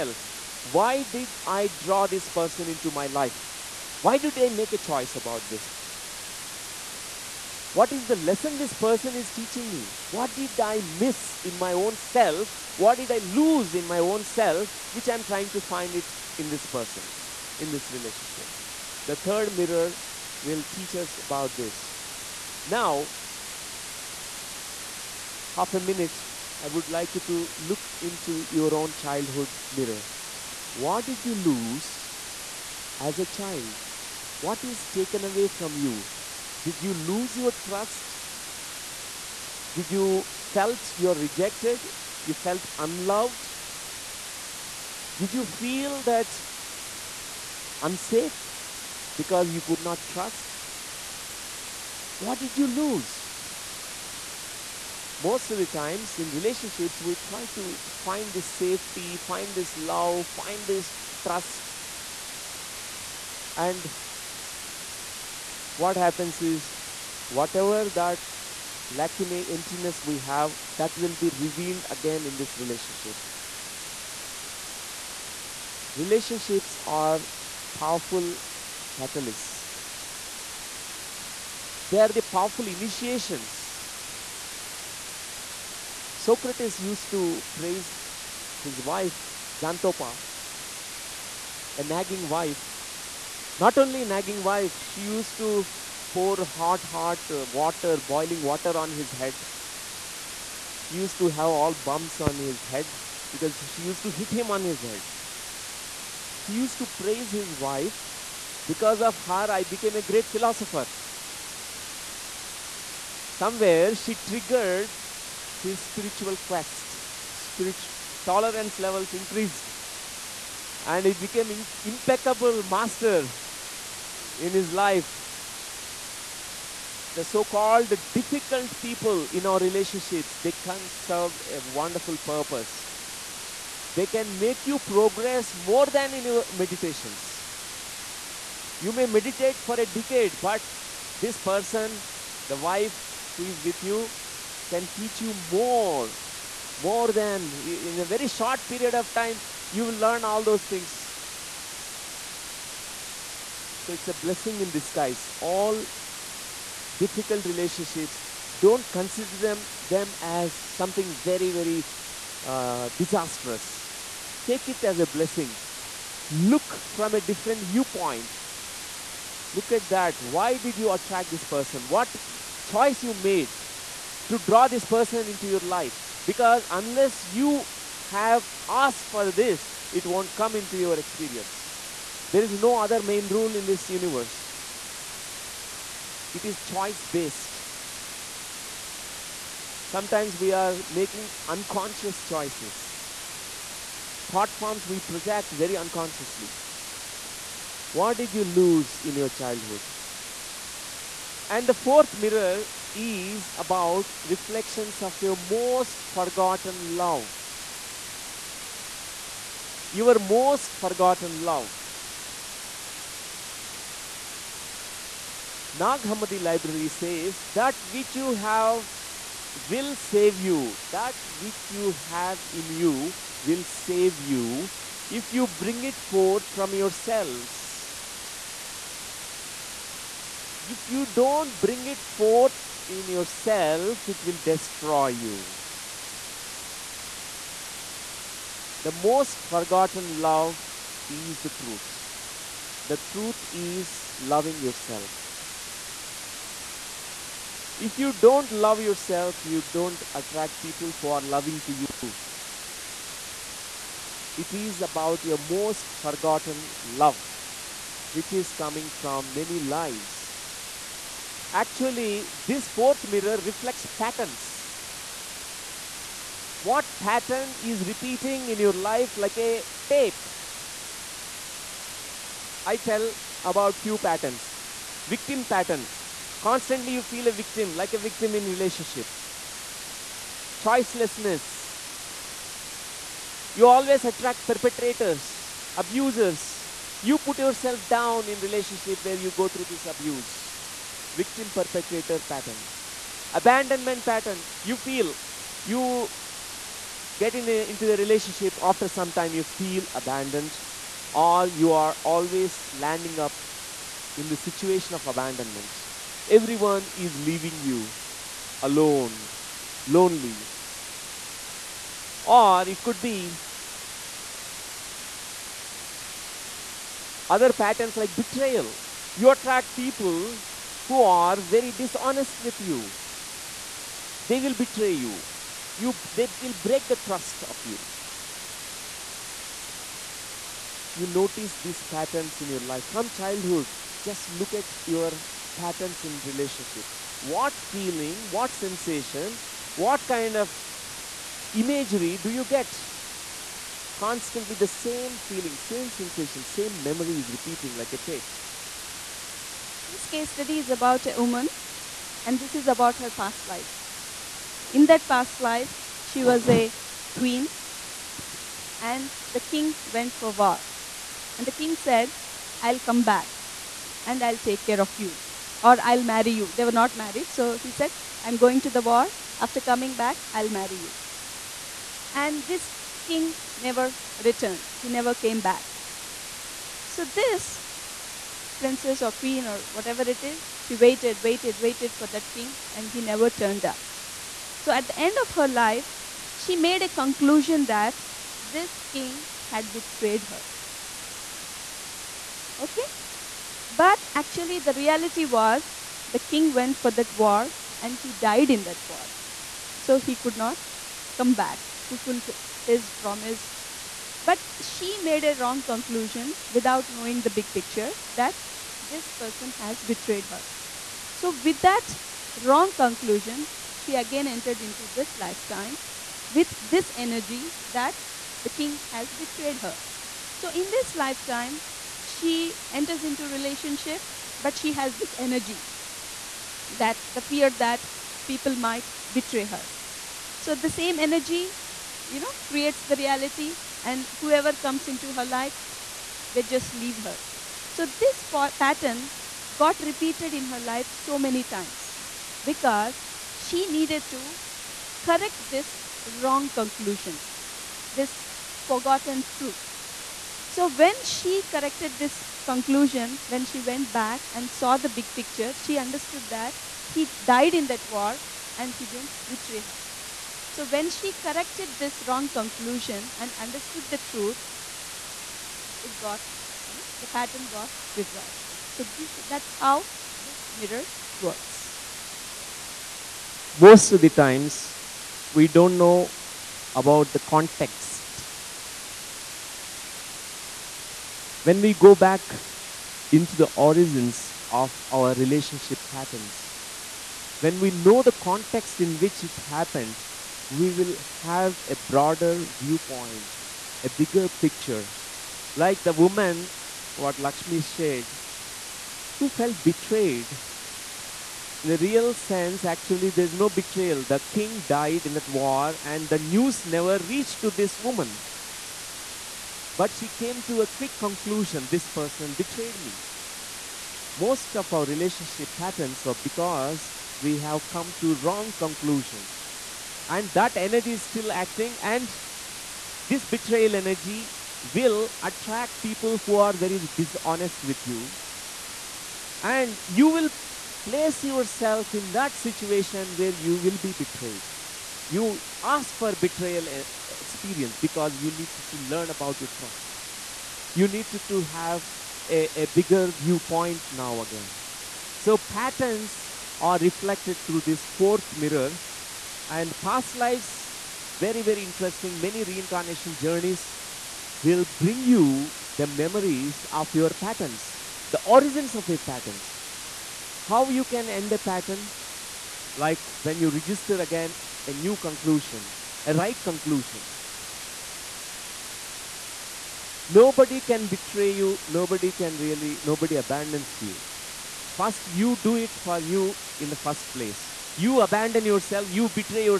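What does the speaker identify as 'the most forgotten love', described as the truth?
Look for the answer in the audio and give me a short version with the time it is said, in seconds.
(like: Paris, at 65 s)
Loving yourself, at 244 s.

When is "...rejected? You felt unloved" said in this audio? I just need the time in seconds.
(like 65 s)
41 s.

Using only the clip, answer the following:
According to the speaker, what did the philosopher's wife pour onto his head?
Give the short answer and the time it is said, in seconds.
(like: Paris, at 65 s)
Boiling water, at 98 s.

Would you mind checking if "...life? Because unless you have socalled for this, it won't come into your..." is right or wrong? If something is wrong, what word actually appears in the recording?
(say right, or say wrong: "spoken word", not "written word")
wrong: "asked", not "socalled".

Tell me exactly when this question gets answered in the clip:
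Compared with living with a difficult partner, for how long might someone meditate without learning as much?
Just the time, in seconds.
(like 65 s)
139 s.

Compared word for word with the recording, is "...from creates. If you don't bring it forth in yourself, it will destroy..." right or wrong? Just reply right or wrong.
wrong.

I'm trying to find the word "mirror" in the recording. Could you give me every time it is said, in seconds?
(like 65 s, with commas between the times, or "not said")
19 s, 29 s, 202 s, 263 s, 470 s, 548 s.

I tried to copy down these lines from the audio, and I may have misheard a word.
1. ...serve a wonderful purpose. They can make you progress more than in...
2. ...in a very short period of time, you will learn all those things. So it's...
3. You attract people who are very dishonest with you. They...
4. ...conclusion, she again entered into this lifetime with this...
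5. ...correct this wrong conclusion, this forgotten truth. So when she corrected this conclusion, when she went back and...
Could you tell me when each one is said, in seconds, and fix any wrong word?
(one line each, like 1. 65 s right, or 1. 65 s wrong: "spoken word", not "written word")
1. 131 s right
2. 147 s right
3. 319 s right
4. 412 s right
5. 445 s right.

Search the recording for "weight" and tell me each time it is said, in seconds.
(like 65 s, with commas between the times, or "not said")
not said.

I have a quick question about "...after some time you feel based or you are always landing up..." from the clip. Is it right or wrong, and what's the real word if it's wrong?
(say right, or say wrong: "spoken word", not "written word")
wrong: "abandoned", not "based".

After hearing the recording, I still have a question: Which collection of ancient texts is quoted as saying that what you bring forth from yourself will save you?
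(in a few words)
Nag Hammadi Library.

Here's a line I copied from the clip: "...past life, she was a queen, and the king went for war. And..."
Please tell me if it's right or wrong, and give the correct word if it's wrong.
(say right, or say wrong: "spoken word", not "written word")
right.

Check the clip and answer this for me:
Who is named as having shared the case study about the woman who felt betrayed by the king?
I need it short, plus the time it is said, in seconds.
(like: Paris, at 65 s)
Lakshmi, at 497 s.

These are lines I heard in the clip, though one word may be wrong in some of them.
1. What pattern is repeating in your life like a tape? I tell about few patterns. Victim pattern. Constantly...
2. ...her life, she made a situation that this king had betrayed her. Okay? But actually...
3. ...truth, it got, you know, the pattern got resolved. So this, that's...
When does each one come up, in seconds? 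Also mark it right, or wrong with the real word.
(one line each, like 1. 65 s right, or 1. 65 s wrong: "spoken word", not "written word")
1. 266 s right
2. 385 s wrong: "conclusion", not "situation"
3. 463 s right.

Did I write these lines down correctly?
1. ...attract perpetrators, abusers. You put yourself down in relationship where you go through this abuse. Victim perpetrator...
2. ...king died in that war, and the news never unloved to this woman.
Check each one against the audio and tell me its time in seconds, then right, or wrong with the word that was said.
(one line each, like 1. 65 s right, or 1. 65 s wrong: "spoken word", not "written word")
1. 284 s right
2. 504 s wrong: "reached", not "unloved".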